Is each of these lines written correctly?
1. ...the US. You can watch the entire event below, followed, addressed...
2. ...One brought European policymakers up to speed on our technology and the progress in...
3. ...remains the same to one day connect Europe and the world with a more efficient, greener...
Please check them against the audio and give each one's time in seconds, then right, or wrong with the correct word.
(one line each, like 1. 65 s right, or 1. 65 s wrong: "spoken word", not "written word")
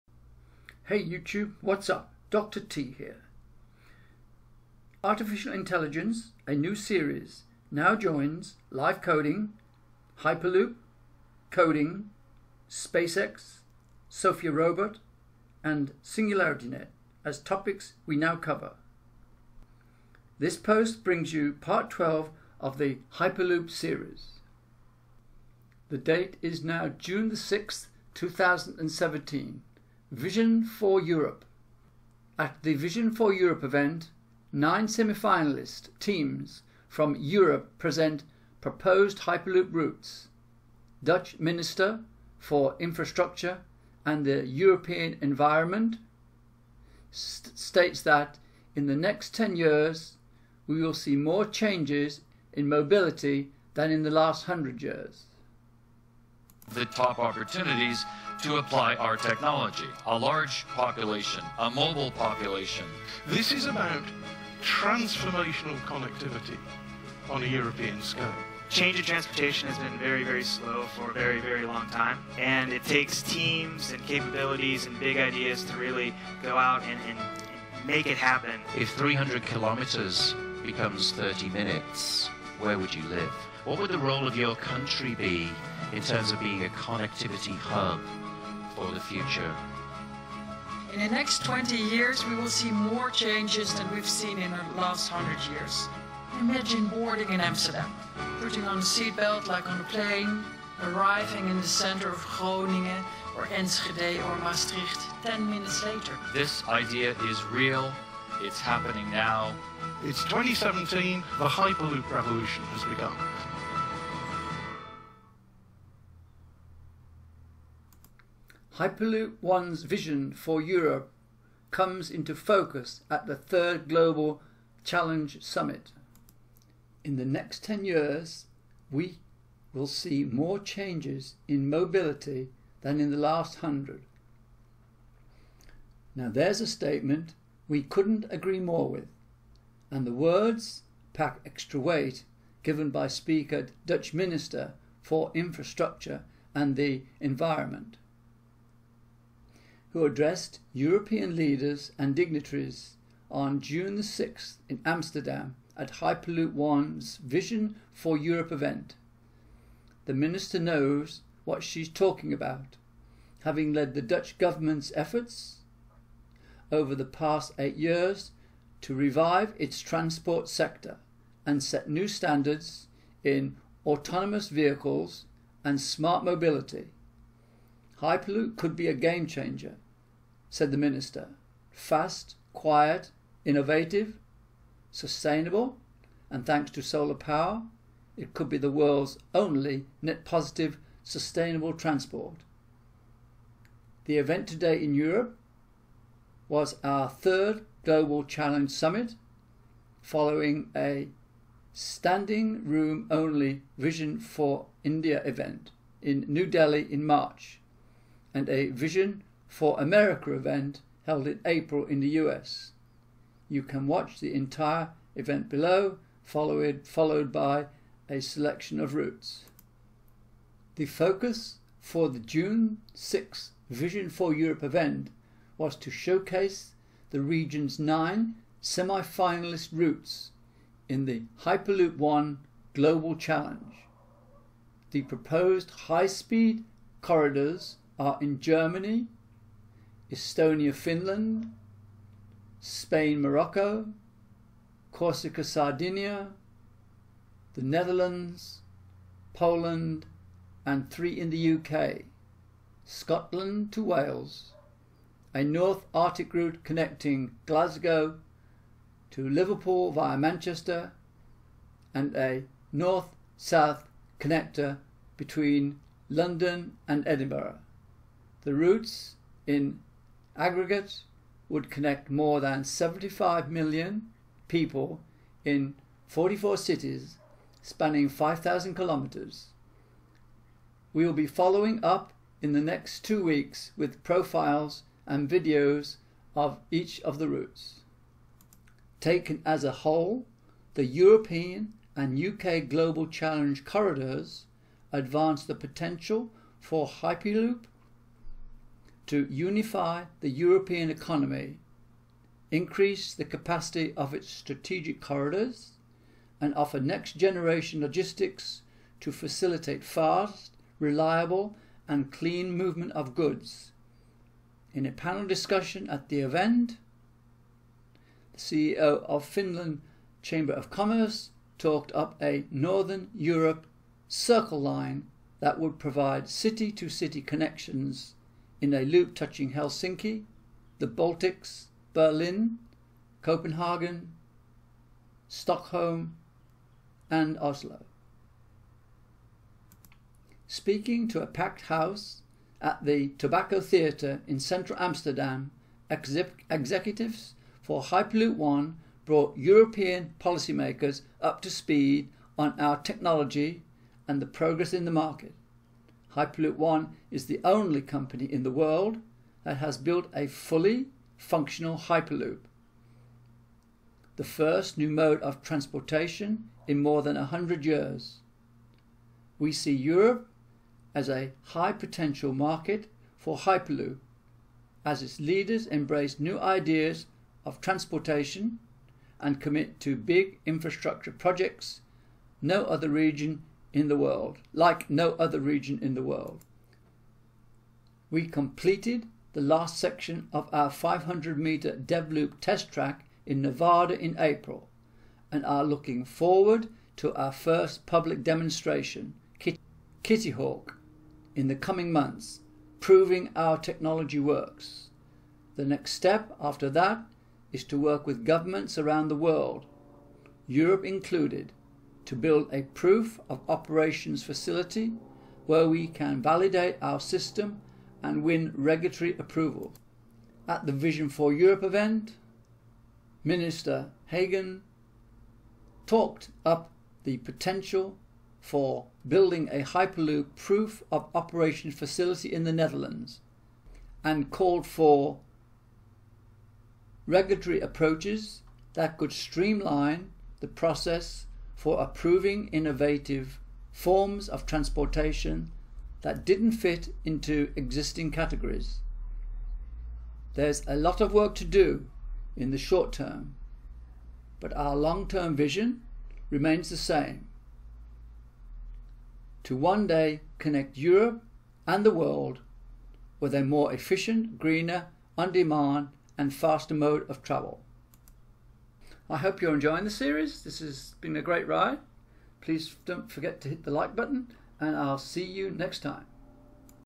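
1. 211 s wrong: "followed", not "addressed"
2. 348 s right
3. 456 s right.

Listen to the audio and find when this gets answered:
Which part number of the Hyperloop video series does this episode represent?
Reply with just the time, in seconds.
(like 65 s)
21 s.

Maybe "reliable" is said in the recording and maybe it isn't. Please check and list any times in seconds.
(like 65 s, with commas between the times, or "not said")
310 s.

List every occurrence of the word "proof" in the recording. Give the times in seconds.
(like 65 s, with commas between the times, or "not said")
412 s, 430 s.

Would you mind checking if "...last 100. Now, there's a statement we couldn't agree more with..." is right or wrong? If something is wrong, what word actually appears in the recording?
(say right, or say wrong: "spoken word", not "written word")
right.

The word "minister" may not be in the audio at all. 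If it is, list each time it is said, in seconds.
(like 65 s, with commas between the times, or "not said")
41 s, 144 s, 160 s, 180 s, 423 s.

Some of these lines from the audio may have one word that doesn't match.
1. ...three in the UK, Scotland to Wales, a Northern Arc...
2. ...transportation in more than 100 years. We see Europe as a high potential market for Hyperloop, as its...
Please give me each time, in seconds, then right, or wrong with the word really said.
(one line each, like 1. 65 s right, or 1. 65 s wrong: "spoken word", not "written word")
1. 250 s right
2. 365 s right.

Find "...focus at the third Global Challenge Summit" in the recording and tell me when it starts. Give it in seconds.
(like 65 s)
122 s.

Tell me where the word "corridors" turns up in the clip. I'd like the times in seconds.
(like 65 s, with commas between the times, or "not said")
237 s, 293 s, 305 s.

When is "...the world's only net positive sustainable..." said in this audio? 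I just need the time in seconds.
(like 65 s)
188 s.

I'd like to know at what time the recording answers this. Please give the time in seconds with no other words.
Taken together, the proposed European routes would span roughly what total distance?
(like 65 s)
278 s.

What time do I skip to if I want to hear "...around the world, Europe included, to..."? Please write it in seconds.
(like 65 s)
408 s.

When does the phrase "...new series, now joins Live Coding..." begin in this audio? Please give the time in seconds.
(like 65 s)
6 s.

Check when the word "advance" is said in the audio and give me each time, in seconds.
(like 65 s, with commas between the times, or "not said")
294 s.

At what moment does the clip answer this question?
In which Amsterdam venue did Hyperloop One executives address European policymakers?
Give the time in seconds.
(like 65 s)
343 s.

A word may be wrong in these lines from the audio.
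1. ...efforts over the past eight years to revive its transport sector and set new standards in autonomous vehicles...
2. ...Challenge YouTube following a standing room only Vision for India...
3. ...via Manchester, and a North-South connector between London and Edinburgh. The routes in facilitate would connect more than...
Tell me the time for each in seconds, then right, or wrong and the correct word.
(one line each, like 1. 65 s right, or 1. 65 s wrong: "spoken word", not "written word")
1. 164 s right
2. 198 s wrong: "Summit", not "YouTube"
3. 259 s wrong: "aggregate", not "facilitate".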